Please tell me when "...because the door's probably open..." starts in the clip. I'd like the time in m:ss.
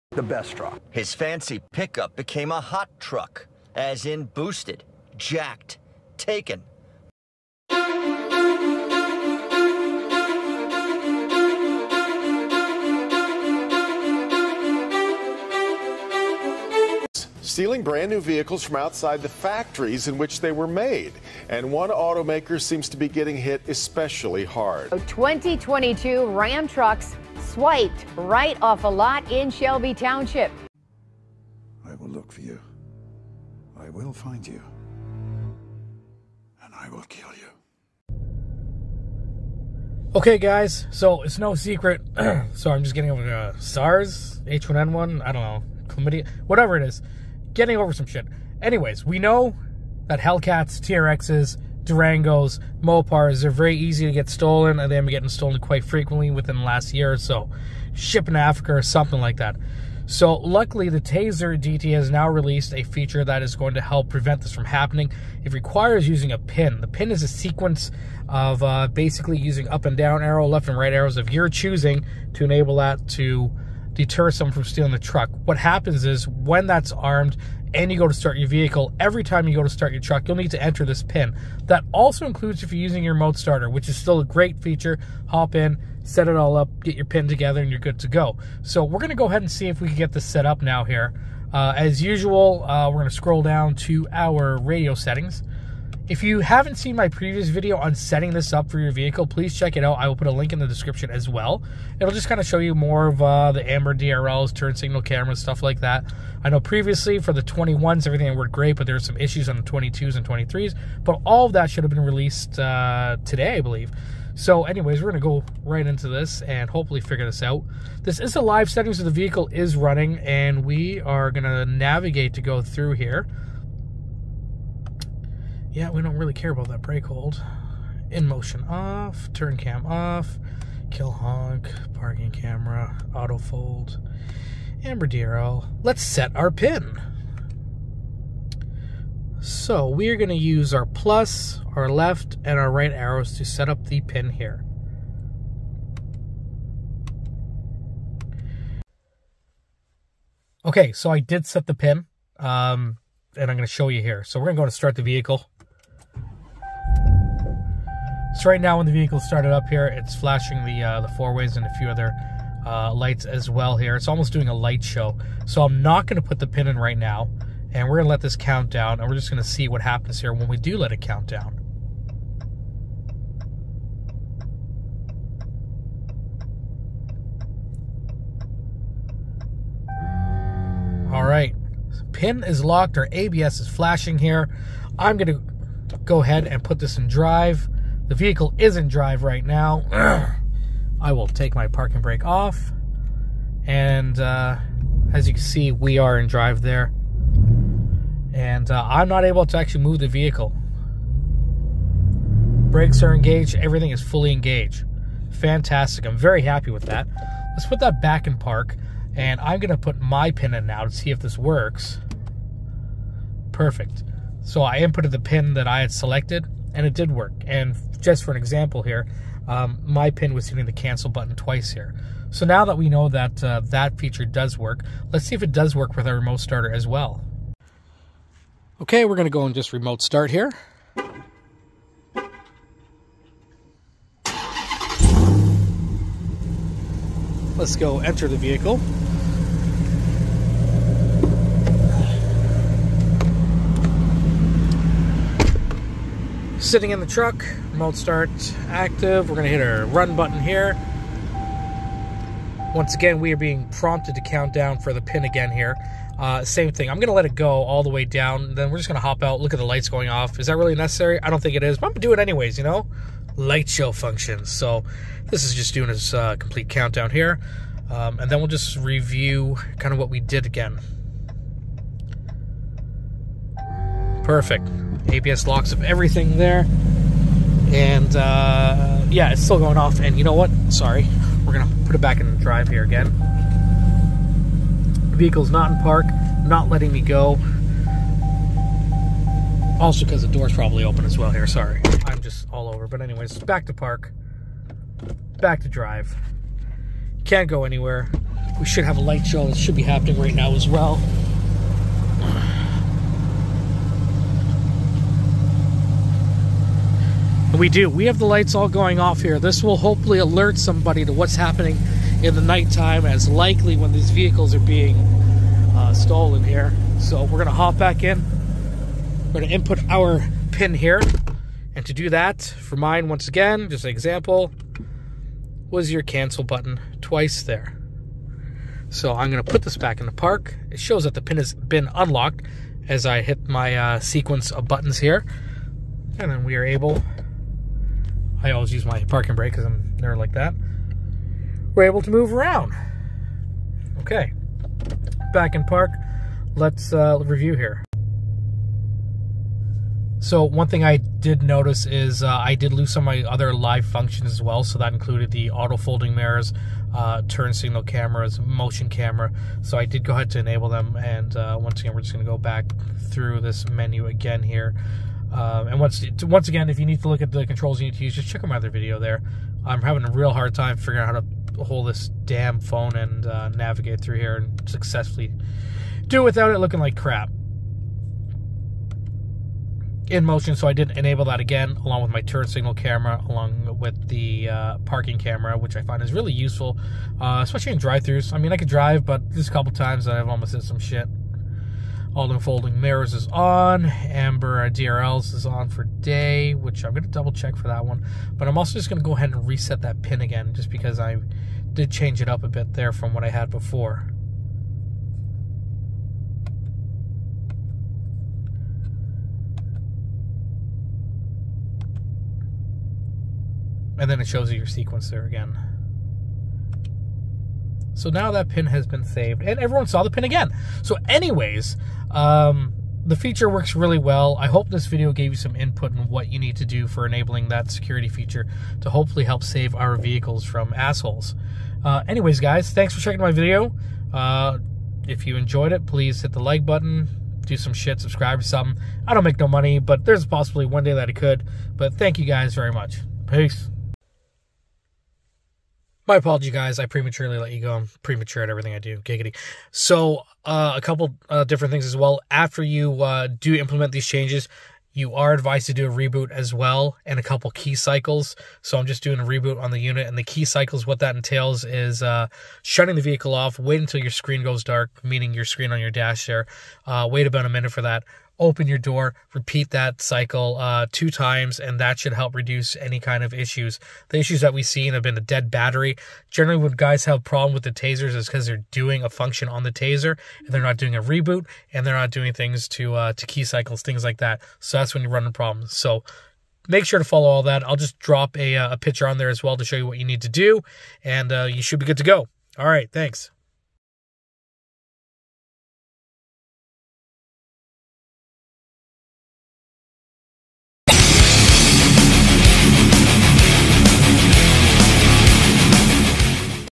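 4:50.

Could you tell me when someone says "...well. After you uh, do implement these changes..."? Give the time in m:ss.
7:31.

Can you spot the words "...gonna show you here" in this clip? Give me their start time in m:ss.
2:33.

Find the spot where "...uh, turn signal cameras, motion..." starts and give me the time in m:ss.
5:56.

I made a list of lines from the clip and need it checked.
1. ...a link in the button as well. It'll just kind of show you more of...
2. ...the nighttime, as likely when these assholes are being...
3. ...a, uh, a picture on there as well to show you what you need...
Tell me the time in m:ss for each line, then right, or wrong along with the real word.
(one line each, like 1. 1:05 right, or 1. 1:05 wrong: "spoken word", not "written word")
1. 1:40 wrong: "description", not "button"
2. 5:12 wrong: "vehicles", not "assholes"
3. 8:08 right.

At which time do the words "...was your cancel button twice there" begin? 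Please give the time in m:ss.
5:25.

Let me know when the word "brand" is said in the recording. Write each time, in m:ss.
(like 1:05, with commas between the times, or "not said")
0:17.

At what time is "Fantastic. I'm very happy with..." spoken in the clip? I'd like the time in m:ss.
3:25.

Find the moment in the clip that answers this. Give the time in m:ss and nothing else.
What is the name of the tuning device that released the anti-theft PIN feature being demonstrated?
1:00.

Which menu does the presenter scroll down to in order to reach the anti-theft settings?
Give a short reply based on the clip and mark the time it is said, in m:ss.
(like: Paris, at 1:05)
radio settings, at 1:34.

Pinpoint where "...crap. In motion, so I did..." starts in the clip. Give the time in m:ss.
6:16.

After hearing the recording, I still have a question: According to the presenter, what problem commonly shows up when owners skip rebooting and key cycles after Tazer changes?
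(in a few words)
dead battery.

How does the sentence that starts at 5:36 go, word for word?
And then we are able I always use my parking brake because I'm there like that.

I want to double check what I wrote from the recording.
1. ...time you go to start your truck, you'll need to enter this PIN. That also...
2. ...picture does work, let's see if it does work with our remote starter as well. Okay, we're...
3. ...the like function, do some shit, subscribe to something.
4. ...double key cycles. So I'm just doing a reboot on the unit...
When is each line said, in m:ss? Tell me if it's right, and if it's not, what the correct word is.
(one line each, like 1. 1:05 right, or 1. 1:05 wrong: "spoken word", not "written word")
1. 1:19 right
2. 3:43 wrong: "feature", not "picture"
3. 7:16 wrong: "button", not "function"
4. 7:37 wrong: "couple", not "double".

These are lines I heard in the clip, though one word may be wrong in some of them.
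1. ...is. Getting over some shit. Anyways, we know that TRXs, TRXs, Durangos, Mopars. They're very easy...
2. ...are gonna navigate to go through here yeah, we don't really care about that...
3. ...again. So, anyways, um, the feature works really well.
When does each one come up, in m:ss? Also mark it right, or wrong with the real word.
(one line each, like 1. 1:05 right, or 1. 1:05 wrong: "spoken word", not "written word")
1. 0:46 wrong: "Hellcats", not "TRXs"
2. 2:00 right
3. 7:00 right.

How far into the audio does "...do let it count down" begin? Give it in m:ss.
2:50.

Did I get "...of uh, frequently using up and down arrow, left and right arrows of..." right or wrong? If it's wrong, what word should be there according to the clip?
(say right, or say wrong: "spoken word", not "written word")
wrong: "basically", not "frequently".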